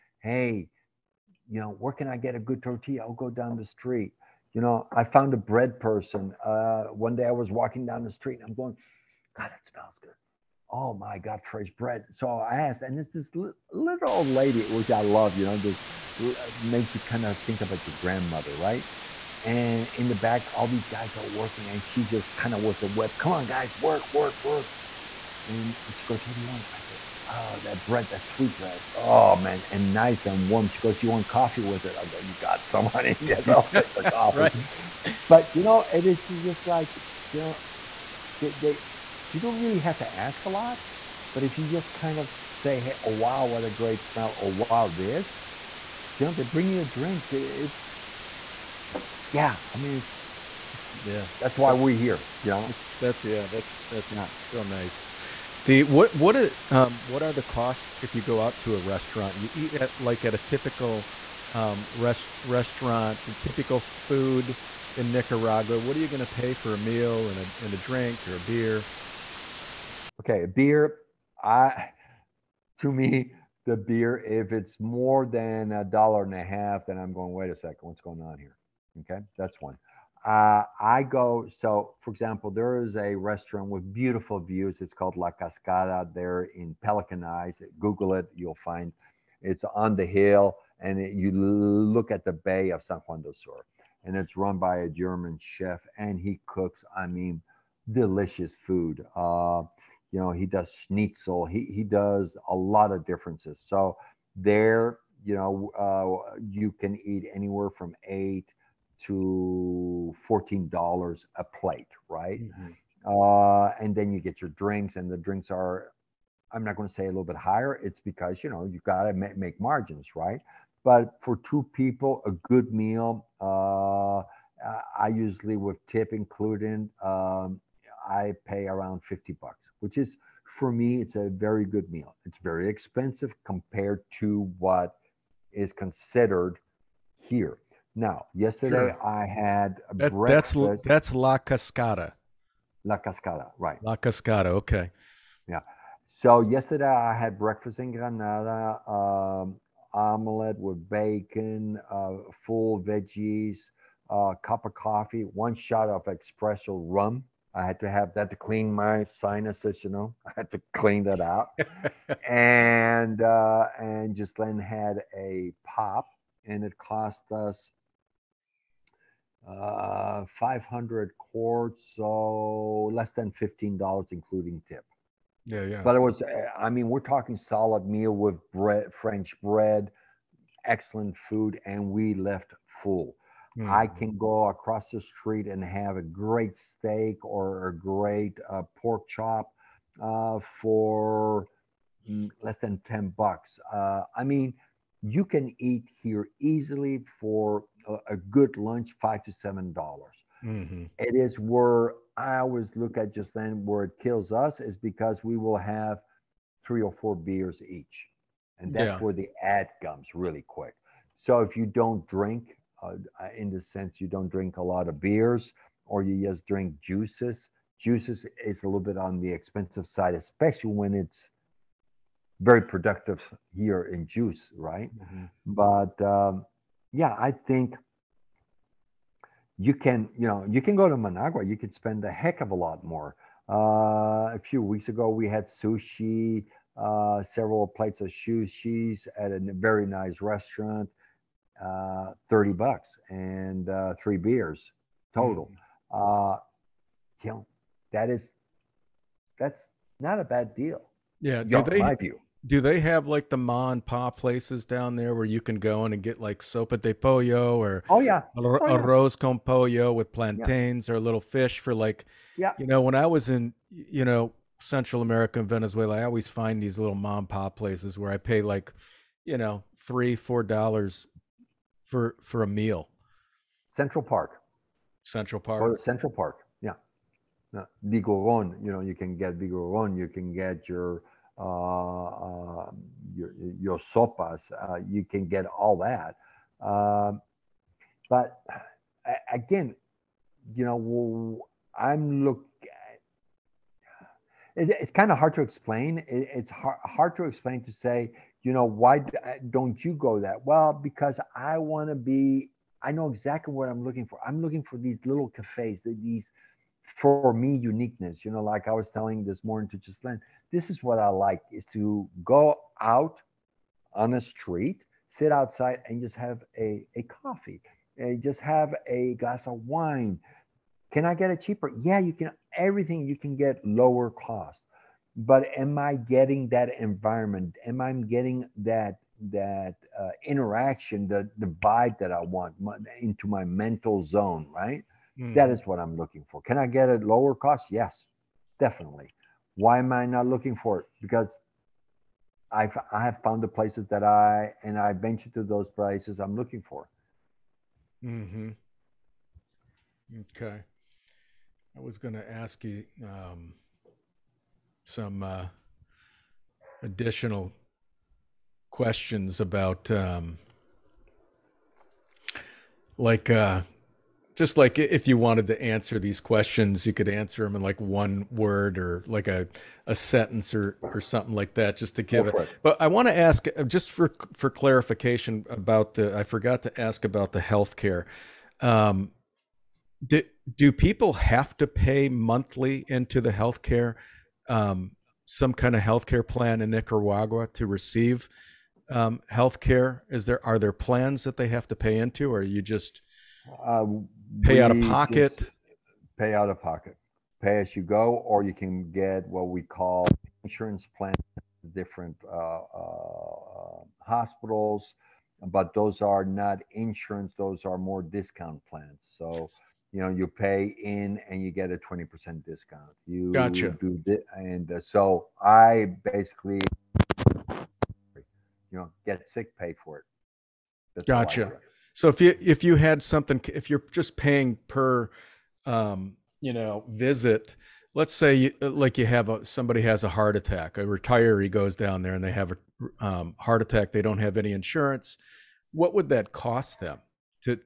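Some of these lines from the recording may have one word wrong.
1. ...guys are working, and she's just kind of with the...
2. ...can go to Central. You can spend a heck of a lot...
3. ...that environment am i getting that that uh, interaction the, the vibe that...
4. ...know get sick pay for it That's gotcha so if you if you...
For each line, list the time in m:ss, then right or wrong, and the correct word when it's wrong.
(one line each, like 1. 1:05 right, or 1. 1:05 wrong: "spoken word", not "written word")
1. 0:20 right
2. 3:50 wrong: "Managua", not "Central"
3. 5:26 right
4. 6:58 right.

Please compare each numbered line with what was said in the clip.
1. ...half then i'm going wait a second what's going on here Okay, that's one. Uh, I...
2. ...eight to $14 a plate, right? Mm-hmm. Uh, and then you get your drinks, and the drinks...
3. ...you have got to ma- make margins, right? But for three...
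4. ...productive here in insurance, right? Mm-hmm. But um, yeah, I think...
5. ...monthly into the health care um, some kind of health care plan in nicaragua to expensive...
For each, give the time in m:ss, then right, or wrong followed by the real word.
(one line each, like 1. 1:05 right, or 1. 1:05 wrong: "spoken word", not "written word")
1. 1:16 right
2. 1:48 right
3. 1:58 wrong: "two", not "three"
4. 3:42 wrong: "juice", not "insurance"
5. 6:22 wrong: "receive", not "expensive".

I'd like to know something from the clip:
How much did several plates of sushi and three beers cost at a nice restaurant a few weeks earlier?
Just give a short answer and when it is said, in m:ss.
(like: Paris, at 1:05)
$30, at 4:02.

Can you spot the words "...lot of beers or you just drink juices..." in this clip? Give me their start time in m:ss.
3:34.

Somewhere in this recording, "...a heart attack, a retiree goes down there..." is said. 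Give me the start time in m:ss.
7:10.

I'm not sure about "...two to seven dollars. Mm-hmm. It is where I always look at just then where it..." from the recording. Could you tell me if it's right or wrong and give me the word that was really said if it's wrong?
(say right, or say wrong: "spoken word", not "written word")
wrong: "five", not "two".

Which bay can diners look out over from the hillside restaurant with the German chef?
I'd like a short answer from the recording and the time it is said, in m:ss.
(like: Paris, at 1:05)
San Juan del Sur, at 1:32.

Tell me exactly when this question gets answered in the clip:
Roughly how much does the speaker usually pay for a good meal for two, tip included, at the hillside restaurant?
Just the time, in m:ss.
2:09.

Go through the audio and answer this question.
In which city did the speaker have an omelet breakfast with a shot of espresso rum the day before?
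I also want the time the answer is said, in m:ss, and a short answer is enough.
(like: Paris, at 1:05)
Granada, at 2:27.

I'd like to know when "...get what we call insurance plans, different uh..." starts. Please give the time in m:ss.
6:38.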